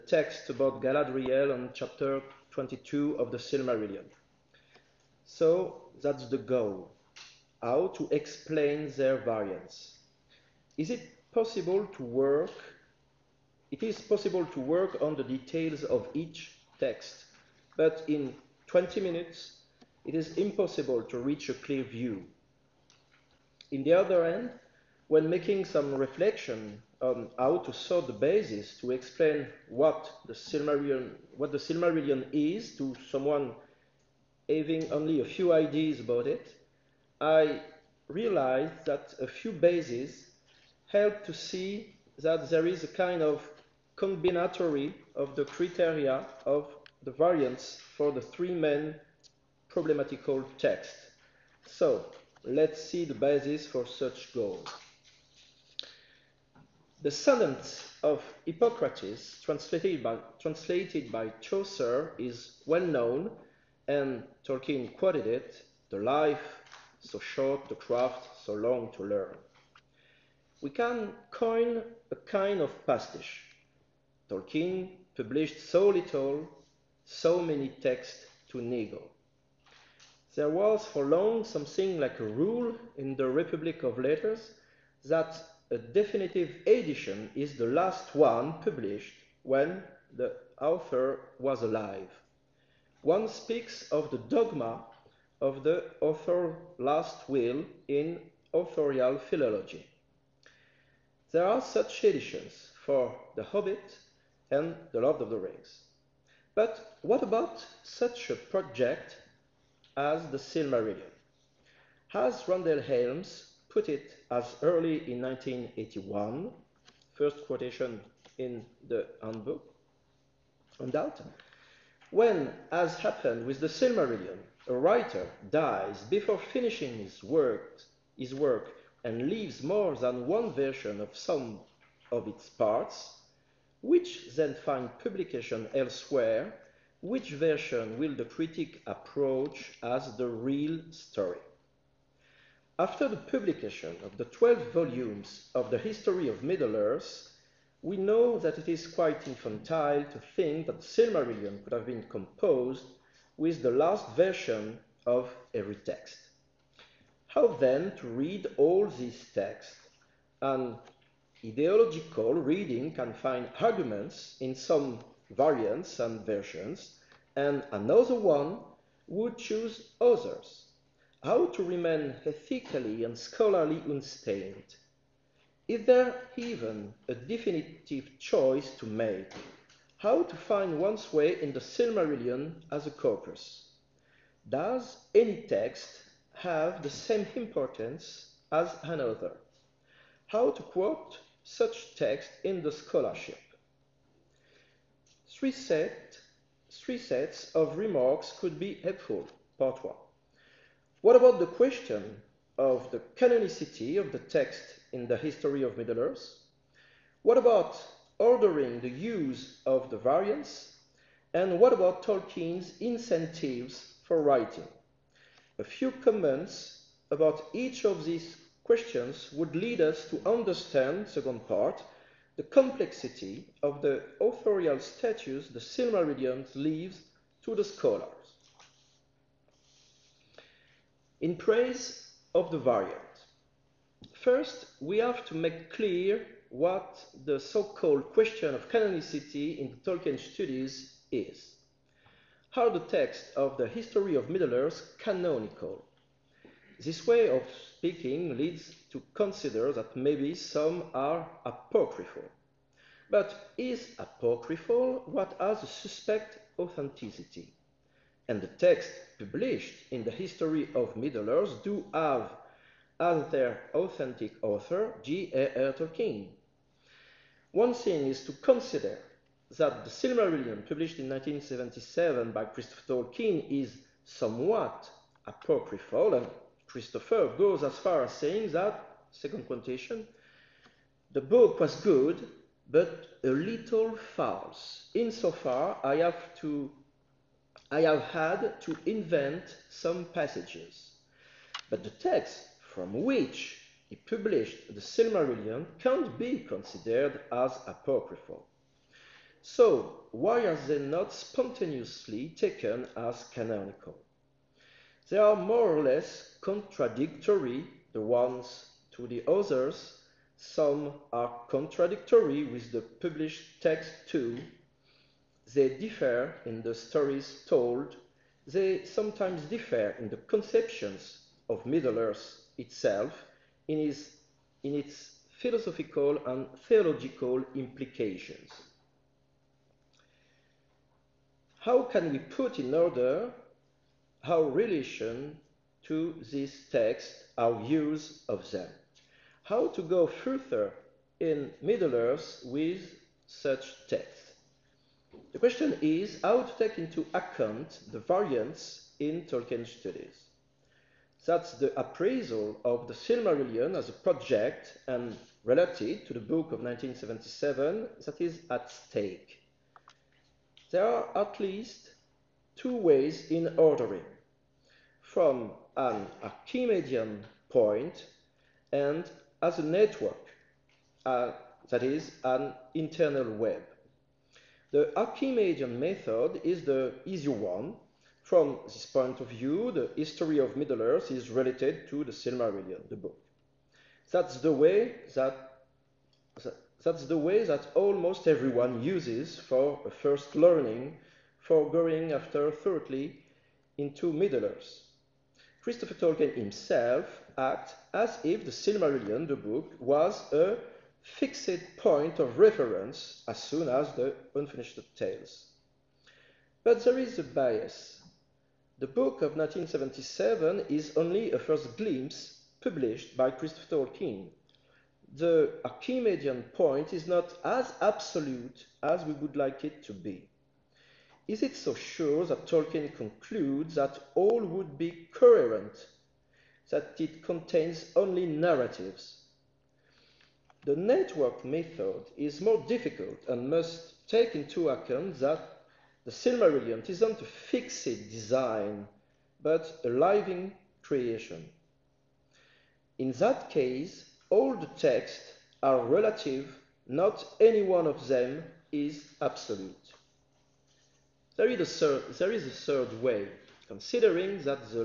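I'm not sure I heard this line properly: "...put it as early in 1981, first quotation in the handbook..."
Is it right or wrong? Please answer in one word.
right.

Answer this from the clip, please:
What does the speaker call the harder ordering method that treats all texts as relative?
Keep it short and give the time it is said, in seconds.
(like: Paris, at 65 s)
network method, at 430 s.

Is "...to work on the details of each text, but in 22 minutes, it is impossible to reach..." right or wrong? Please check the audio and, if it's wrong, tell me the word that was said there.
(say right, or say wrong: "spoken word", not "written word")
wrong: "20", not "22".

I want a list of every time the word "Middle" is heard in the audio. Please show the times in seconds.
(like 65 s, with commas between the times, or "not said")
146 s, 205 s, 244 s, 260 s, 321 s, 341 s, 380 s, 394 s.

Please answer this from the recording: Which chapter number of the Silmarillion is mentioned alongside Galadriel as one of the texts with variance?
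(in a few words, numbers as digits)
22.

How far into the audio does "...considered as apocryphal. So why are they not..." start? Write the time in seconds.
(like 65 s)
296 s.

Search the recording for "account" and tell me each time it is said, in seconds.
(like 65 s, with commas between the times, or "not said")
347 s, 434 s.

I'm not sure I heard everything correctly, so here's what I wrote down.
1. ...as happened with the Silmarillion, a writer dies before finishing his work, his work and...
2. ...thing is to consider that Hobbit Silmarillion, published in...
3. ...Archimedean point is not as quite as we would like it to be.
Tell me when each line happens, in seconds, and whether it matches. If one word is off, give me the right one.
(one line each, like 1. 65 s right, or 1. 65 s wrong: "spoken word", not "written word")
1. 122 s right
2. 267 s wrong: "The", not "Hobbit"
3. 415 s wrong: "absolute", not "quite".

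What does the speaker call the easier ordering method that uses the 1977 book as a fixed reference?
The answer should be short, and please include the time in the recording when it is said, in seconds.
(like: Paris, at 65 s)
Archimedean method, at 374 s.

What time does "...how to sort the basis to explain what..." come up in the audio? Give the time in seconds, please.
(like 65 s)
27 s.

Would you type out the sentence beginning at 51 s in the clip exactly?
So let's see the basis for such goal.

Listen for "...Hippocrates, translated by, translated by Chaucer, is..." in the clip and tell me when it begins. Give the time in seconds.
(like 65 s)
58 s.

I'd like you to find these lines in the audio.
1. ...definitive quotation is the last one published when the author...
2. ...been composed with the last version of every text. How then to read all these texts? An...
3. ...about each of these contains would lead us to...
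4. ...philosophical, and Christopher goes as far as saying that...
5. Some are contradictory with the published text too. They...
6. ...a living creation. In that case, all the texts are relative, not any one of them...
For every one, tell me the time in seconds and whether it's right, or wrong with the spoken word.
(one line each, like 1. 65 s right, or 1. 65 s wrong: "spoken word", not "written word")
1. 85 s wrong: "edition", not "quotation"
2. 151 s right
3. 217 s wrong: "questions", not "contains"
4. 275 s wrong: "apocryphal", not "philosophical"
5. 310 s right
6. 439 s right.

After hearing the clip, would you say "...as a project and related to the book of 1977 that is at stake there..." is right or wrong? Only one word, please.
right.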